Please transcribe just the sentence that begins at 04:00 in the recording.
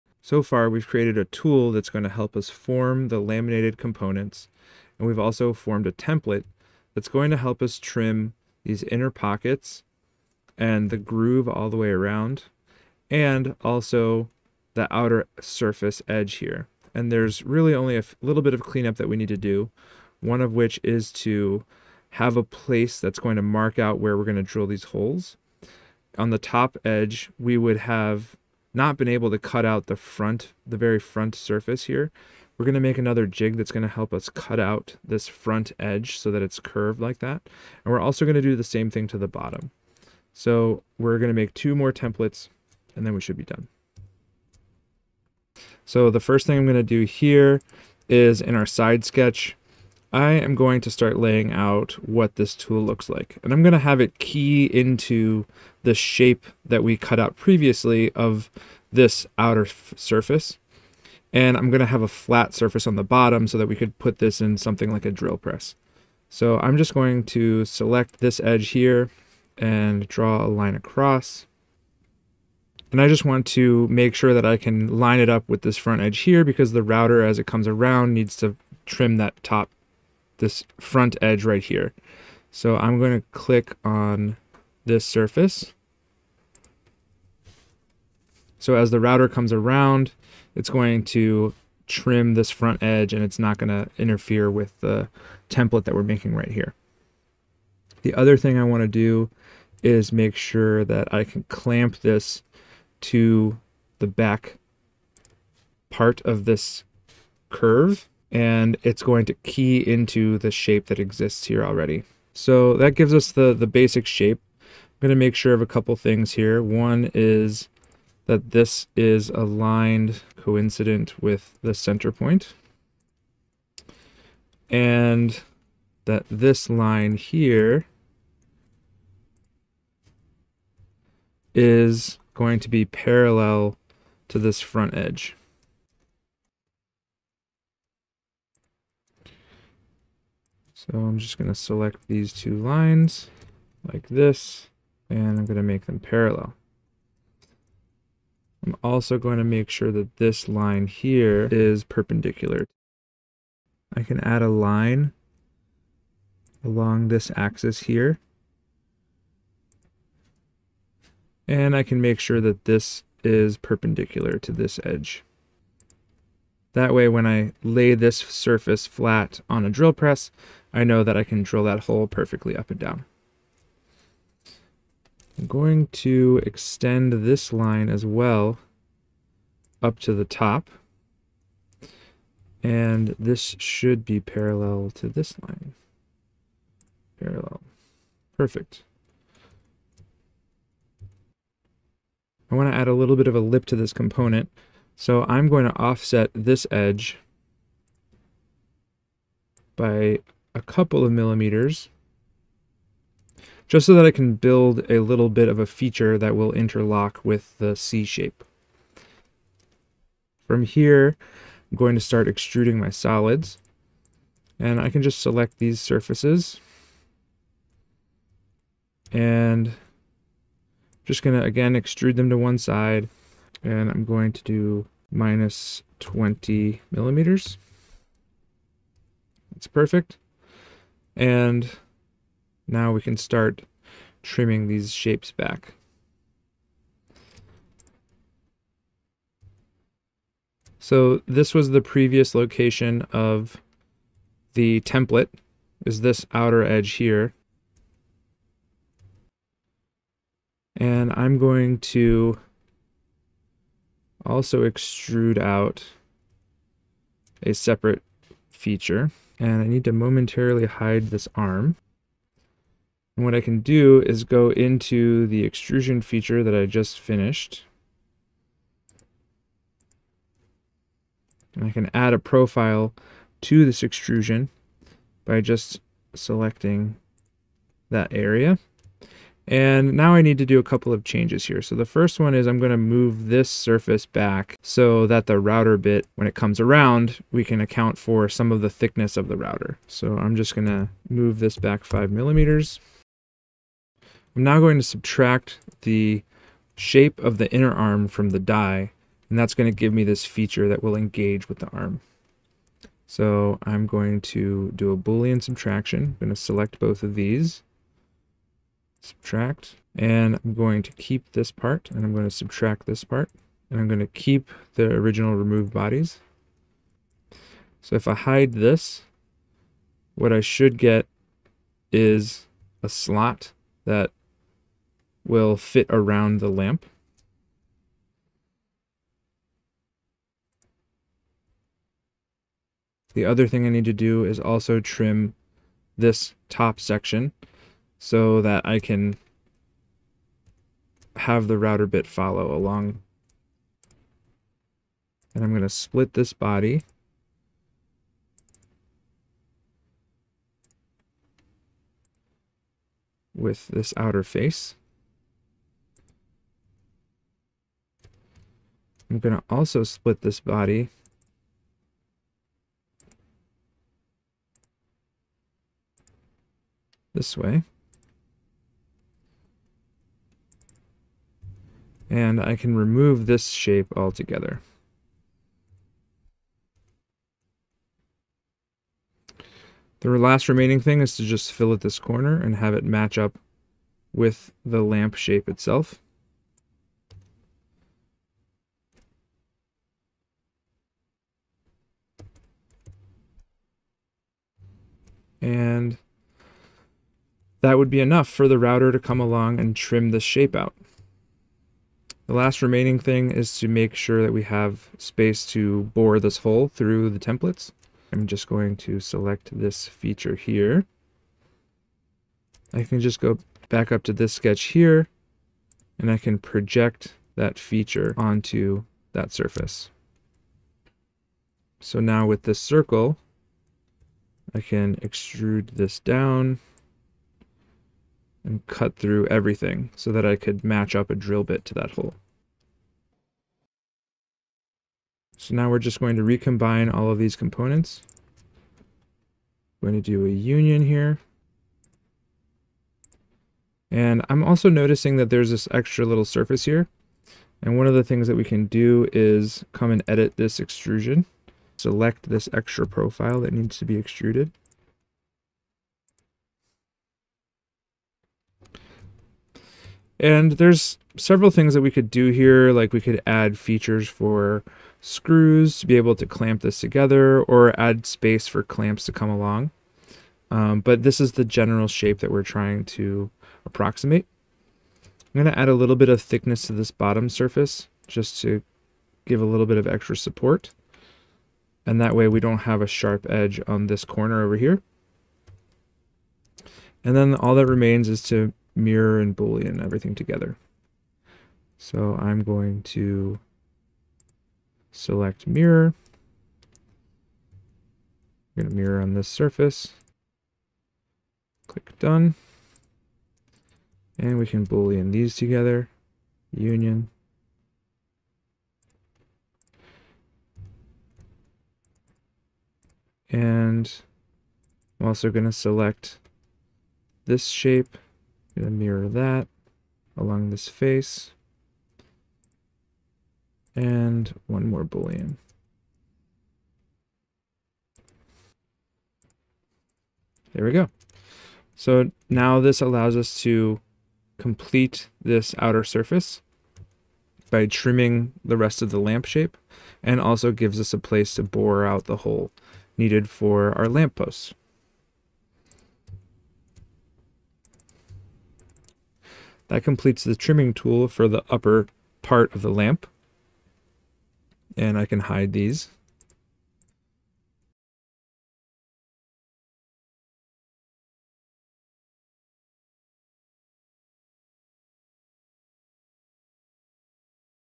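So this was the previous location of the template, is this outer edge here.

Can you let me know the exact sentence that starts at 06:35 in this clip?
And that would be enough for the router to come along and trim this shape out.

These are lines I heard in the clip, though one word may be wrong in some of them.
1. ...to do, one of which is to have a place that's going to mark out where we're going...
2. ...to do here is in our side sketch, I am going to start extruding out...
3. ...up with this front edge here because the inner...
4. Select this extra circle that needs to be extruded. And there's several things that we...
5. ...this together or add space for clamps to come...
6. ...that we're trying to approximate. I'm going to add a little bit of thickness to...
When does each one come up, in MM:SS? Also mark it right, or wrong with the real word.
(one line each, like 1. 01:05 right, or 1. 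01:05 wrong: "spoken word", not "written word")
1. 00:19 right
2. 00:46 wrong: "laying", not "extruding"
3. 01:15 wrong: "router", not "inner"
4. 07:31 wrong: "profile", not "circle"
5. 07:46 right
6. 07:52 right.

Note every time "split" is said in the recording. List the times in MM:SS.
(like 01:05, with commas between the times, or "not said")
05:45, 05:59.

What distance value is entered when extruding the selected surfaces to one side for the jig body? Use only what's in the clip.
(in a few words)
-20 millimeters.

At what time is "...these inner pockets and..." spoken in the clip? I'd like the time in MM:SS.
00:08.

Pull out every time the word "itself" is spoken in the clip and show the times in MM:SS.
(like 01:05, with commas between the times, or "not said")
06:25.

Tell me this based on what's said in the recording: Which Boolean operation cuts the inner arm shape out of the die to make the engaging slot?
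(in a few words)
subtraction.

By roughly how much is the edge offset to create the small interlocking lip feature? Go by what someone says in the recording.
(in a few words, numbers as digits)
a couple of millimeters.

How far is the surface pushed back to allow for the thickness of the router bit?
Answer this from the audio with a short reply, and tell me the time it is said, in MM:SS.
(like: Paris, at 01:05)
5 millimeters, at 04:51.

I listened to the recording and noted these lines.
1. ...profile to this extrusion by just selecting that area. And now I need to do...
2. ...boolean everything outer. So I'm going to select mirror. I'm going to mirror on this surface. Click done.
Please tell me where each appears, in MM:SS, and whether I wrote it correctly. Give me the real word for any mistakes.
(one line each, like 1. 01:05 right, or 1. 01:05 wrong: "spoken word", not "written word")
1. 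04:32 right
2. 08:09 wrong: "together", not "outer".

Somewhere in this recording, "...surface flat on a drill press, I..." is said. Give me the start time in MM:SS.
02:48.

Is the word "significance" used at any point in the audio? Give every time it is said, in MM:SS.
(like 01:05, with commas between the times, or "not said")
not said.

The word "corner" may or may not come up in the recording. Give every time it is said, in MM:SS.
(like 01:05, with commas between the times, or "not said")
06:21, 08:04.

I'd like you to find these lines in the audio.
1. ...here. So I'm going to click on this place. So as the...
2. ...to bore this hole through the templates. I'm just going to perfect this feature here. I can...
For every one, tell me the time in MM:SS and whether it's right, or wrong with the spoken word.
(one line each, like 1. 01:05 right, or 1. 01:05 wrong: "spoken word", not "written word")
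1. 01:21 wrong: "surface", not "place"
2. 06:45 wrong: "select", not "perfect".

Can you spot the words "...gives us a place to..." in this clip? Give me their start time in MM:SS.
09:00.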